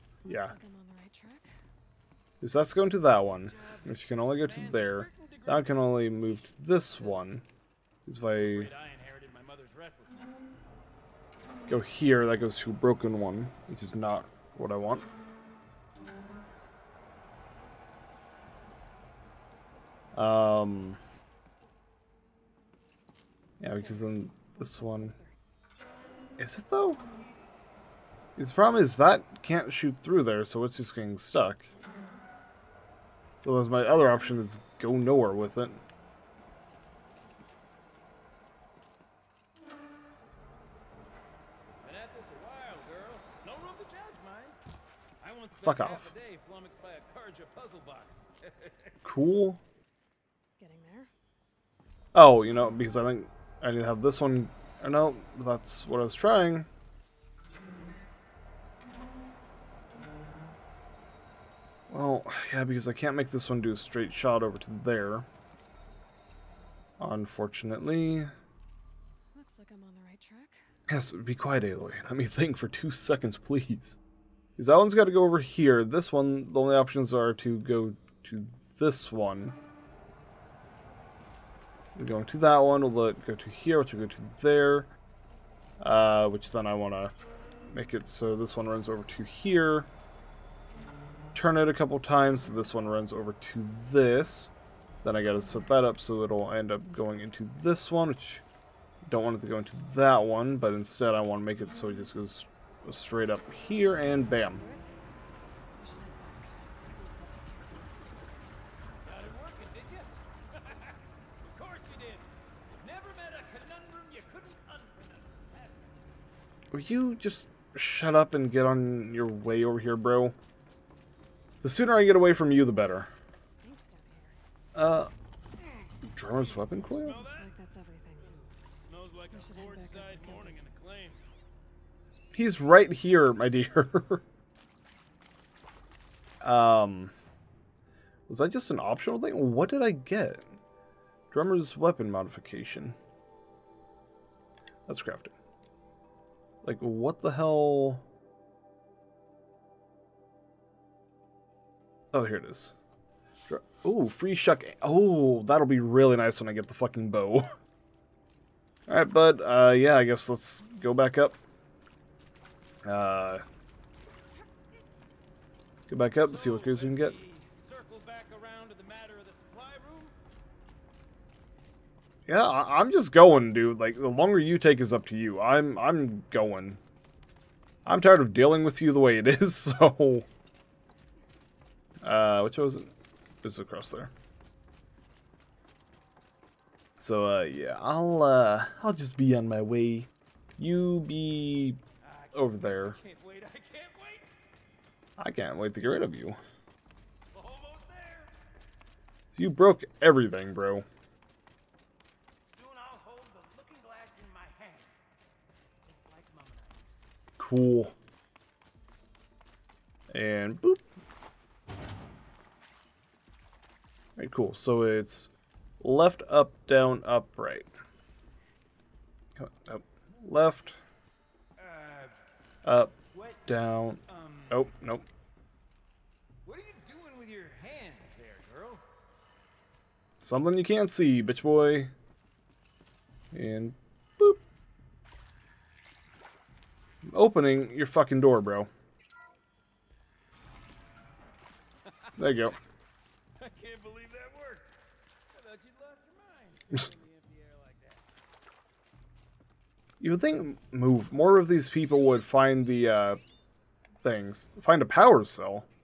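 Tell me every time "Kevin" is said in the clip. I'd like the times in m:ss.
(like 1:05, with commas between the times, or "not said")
not said.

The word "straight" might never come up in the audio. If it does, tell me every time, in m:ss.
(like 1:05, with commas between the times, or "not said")
1:03, 1:42.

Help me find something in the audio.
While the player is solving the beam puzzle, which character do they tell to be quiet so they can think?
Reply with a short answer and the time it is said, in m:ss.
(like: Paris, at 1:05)
Aloy, at 1:11.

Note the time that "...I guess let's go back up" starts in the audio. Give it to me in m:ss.
2:39.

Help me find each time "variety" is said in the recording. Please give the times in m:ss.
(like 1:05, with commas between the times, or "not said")
not said.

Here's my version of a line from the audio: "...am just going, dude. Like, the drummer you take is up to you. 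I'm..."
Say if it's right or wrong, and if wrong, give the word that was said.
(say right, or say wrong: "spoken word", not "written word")
wrong: "longer", not "drummer".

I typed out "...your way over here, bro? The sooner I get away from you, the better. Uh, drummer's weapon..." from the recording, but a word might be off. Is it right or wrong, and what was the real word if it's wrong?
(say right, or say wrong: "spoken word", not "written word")
right.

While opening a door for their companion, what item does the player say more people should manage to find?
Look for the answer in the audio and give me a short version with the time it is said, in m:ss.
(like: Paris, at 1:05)
power cell, at 4:14.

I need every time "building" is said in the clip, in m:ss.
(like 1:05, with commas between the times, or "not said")
not said.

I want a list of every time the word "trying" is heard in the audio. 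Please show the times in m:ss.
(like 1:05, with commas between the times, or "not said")
0:56.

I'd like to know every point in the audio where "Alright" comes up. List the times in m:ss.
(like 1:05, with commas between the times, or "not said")
2:38, 3:34.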